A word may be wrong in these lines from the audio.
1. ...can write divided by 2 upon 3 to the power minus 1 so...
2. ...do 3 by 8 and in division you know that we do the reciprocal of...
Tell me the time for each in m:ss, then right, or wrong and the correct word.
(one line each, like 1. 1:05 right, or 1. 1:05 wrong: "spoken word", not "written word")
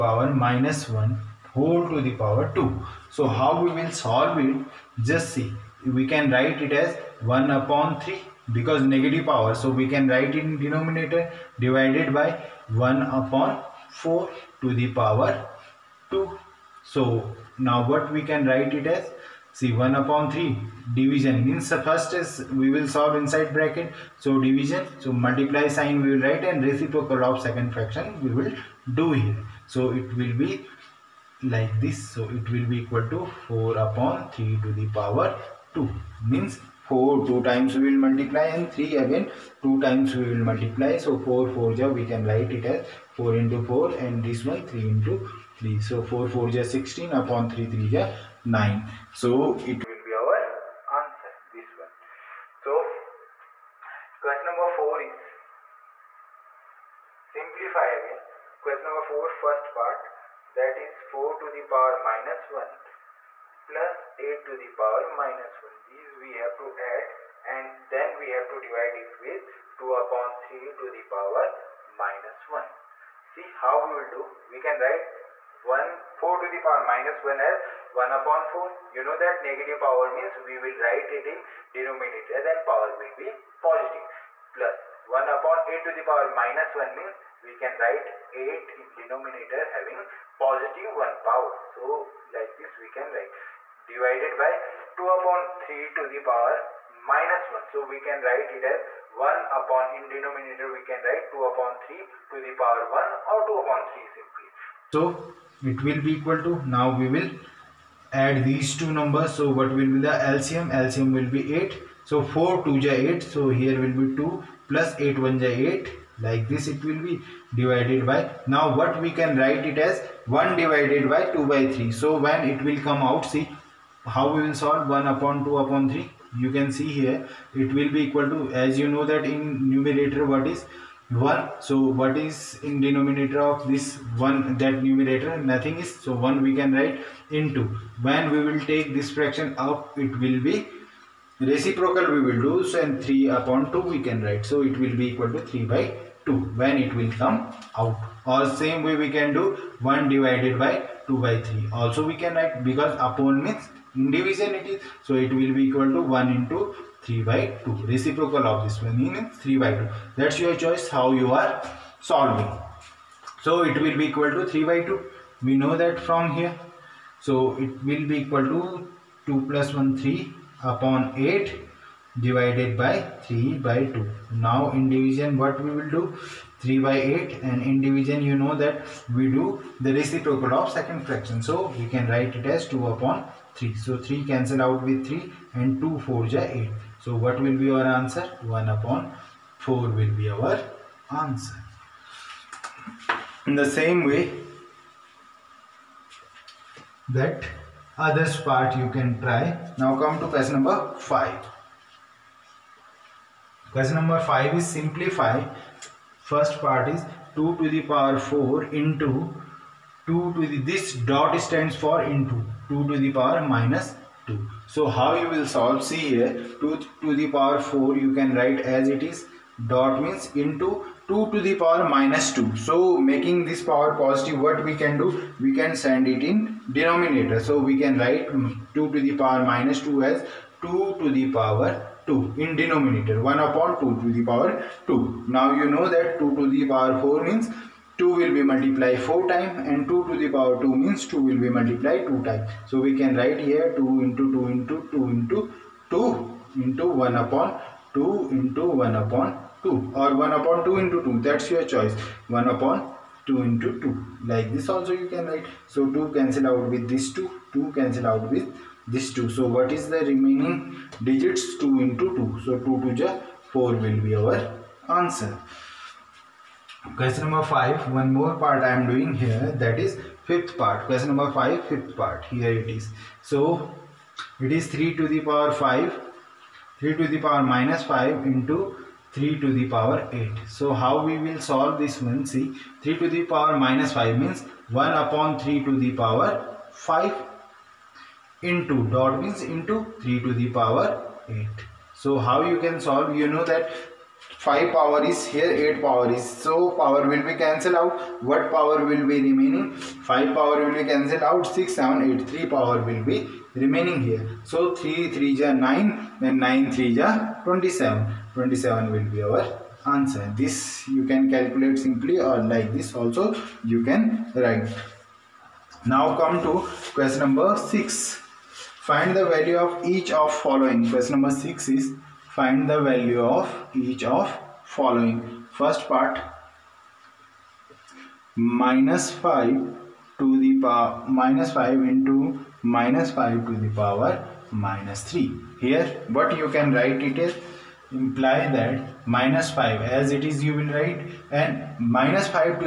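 1. 1:32 right
2. 2:55 right.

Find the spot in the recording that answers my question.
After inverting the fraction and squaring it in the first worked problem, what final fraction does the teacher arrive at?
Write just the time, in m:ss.
0:46.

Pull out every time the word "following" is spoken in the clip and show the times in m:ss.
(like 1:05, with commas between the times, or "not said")
5:20, 5:24.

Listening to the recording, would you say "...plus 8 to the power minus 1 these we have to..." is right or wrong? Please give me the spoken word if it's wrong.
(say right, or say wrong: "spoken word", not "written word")
right.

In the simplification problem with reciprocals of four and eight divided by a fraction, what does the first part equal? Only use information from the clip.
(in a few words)
1/4.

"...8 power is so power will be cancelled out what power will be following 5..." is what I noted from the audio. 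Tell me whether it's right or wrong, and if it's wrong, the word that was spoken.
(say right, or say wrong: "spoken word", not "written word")
wrong: "remaining", not "following".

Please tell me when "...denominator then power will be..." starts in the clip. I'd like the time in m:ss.
1:21.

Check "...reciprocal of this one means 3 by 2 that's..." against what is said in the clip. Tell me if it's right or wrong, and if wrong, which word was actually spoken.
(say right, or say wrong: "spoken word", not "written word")
right.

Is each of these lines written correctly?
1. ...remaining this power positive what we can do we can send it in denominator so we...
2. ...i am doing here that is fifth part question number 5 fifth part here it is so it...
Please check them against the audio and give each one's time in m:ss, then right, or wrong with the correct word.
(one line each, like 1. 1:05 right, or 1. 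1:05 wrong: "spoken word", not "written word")
1. 3:43 wrong: "making", not "remaining"
2. 4:28 right.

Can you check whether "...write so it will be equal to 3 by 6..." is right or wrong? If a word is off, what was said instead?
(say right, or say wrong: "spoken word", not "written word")
wrong: "2", not "6".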